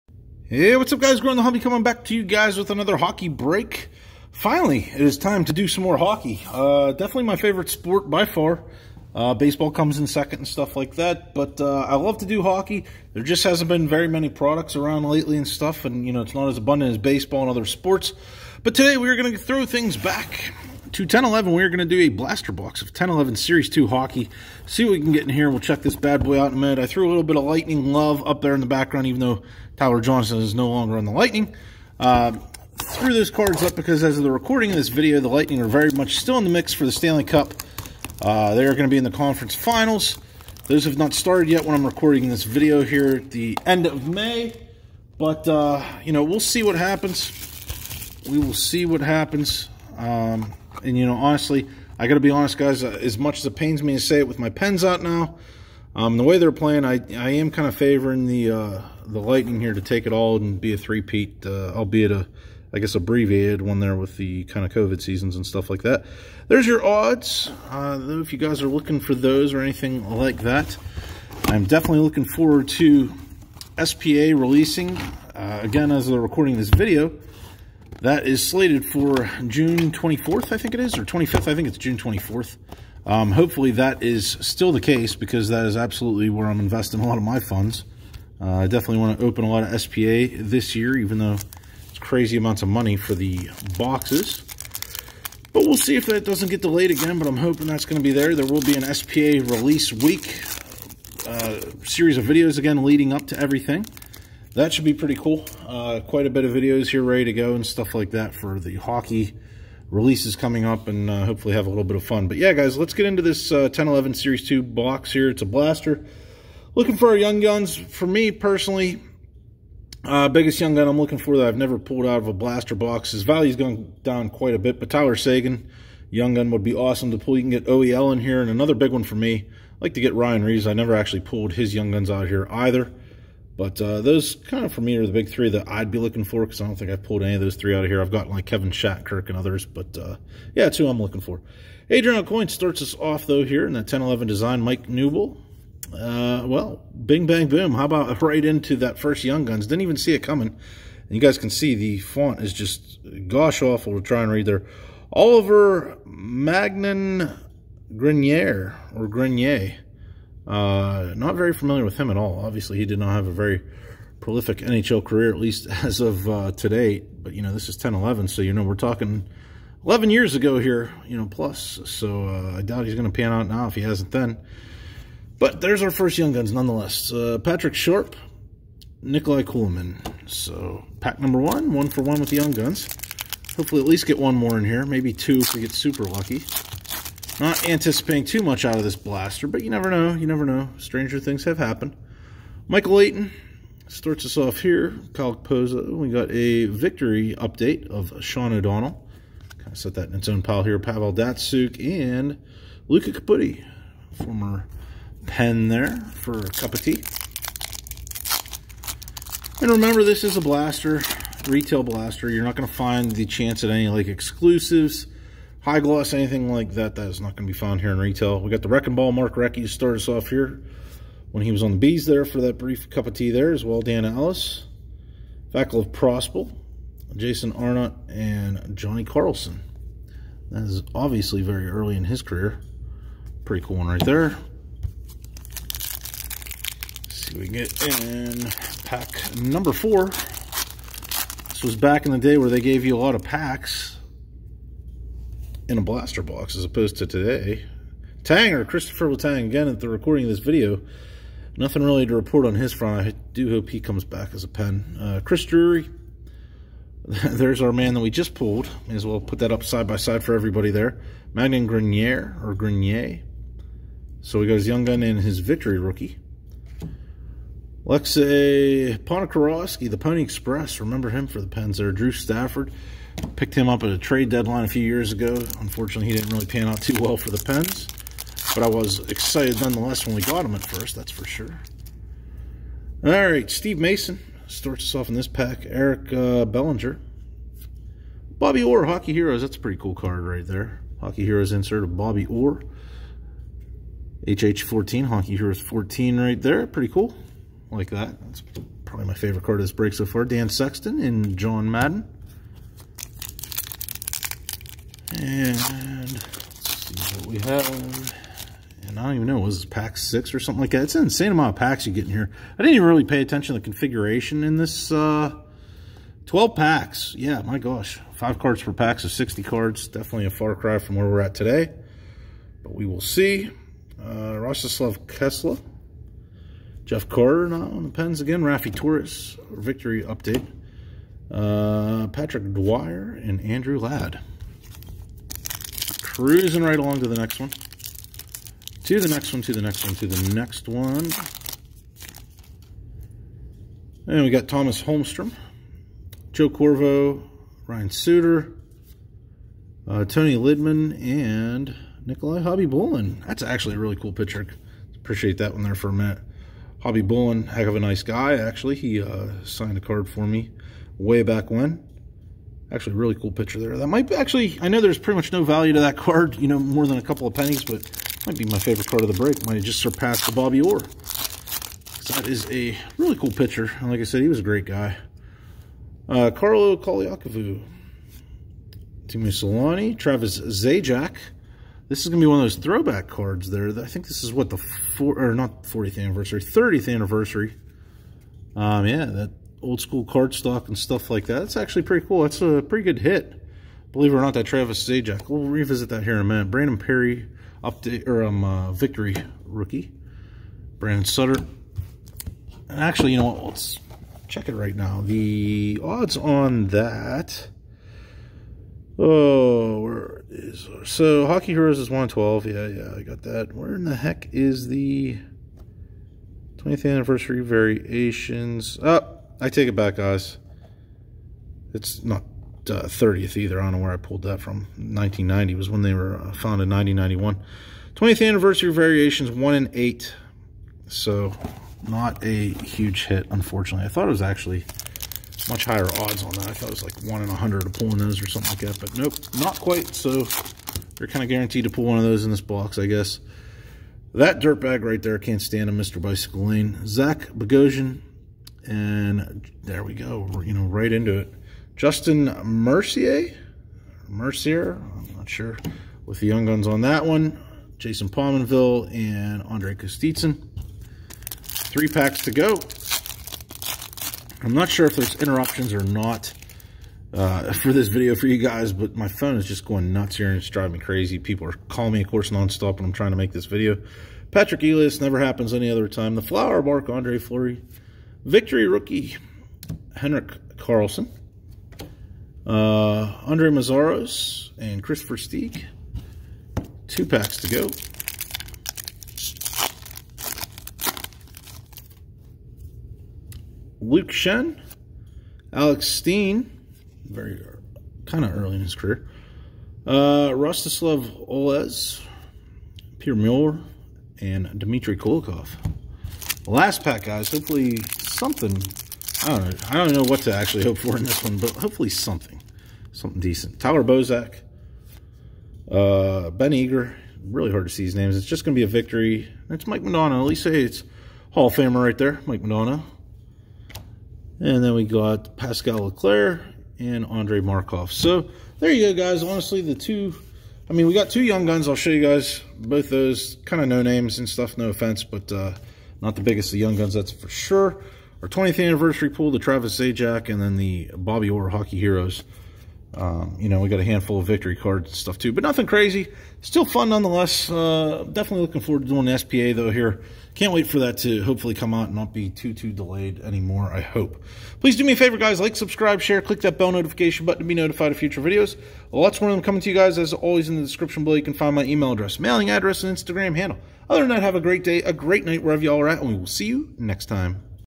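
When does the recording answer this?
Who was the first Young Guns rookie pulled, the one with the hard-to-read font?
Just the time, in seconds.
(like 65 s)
155 s.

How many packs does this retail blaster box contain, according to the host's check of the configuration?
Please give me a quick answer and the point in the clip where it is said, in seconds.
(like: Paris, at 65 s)
12, at 316 s.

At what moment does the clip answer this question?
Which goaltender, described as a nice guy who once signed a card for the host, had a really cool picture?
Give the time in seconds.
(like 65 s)
352 s.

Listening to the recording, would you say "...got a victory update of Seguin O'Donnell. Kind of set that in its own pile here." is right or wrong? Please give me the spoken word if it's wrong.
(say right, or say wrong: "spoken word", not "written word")
wrong: "Sean", not "Seguin".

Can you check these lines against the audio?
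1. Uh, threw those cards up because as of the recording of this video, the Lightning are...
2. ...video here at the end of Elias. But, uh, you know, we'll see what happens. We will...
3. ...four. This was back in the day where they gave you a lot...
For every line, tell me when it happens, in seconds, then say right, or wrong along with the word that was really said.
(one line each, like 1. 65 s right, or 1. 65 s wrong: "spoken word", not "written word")
1. 31 s right
2. 42 s wrong: "May", not "Elias"
3. 239 s right.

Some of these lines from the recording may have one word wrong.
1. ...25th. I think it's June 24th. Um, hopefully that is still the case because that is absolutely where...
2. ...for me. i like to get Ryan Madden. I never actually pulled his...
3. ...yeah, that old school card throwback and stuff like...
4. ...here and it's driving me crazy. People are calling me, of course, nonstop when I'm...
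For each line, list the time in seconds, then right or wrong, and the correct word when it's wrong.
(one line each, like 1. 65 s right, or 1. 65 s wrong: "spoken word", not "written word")
1. 81 s right
2. 129 s wrong: "Reaves", not "Madden"
3. 388 s wrong: "stock", not "throwback"
4. 470 s right.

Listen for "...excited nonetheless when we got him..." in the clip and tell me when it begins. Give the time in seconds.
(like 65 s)
279 s.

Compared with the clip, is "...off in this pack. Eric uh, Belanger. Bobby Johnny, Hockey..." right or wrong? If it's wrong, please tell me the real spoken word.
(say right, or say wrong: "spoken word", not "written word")
wrong: "Orr", not "Johnny".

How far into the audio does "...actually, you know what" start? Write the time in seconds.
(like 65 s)
402 s.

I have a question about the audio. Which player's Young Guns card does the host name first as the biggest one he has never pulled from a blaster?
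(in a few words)
Tyler Seguin.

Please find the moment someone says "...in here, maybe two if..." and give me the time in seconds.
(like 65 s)
184 s.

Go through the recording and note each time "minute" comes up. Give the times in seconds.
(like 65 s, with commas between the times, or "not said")
26 s, 355 s, 396 s.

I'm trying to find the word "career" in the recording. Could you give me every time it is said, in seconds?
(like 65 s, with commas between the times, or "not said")
165 s, 232 s, 498 s.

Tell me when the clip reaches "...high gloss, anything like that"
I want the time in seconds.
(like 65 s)
215 s.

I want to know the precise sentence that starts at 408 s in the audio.
Oh, so Hockey Heroes is 112.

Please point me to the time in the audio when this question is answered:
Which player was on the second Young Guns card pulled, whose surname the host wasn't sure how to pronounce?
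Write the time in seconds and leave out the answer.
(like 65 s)
451 s.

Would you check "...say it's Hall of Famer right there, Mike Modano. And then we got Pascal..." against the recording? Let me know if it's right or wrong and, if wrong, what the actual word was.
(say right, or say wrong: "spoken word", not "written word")
right.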